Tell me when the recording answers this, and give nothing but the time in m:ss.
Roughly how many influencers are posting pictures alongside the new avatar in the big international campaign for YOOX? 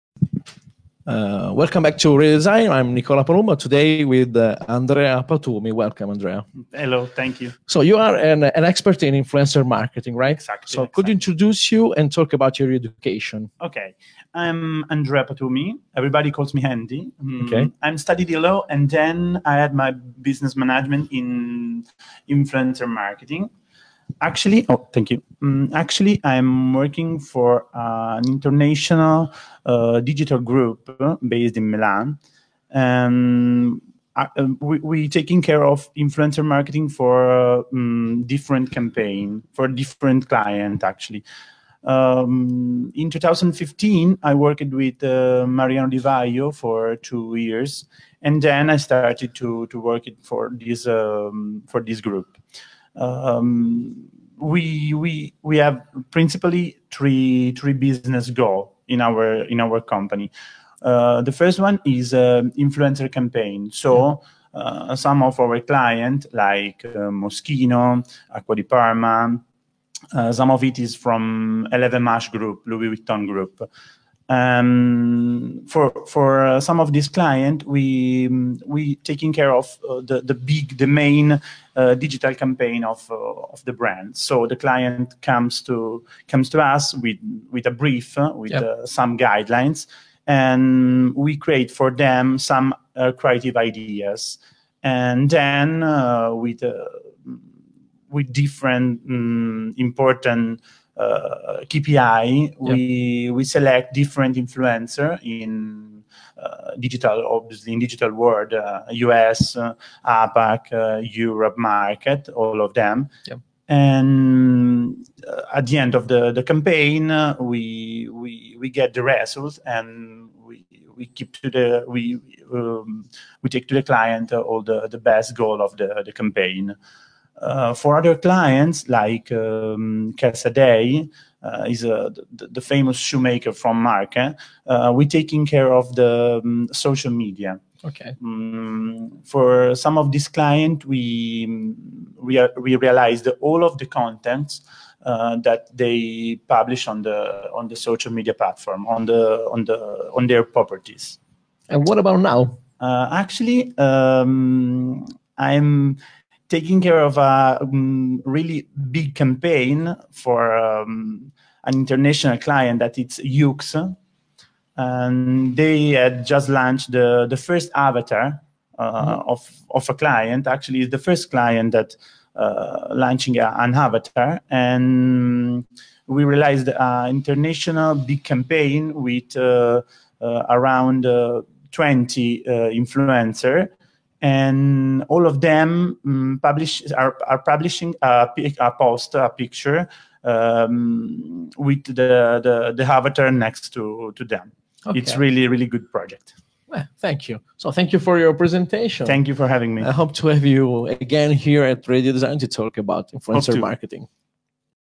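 3:01.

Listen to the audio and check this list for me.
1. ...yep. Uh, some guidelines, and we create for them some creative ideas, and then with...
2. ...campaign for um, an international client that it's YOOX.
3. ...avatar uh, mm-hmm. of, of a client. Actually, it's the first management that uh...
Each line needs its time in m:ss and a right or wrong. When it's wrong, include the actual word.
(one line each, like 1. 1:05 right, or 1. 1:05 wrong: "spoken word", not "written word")
1. 1:28 right
2. 2:39 right
3. 2:47 wrong: "client", not "management".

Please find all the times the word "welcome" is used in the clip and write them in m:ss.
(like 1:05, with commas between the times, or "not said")
0:01, 0:05.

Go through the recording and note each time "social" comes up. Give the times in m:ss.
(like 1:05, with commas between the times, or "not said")
2:16, 2:27.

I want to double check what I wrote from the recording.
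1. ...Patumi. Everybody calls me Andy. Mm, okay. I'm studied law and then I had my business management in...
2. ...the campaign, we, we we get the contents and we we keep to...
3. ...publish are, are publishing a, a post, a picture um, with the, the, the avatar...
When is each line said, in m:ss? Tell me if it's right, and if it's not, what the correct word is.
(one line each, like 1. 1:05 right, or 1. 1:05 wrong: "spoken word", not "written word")
1. 0:15 right
2. 1:56 wrong: "results", not "contents"
3. 3:06 right.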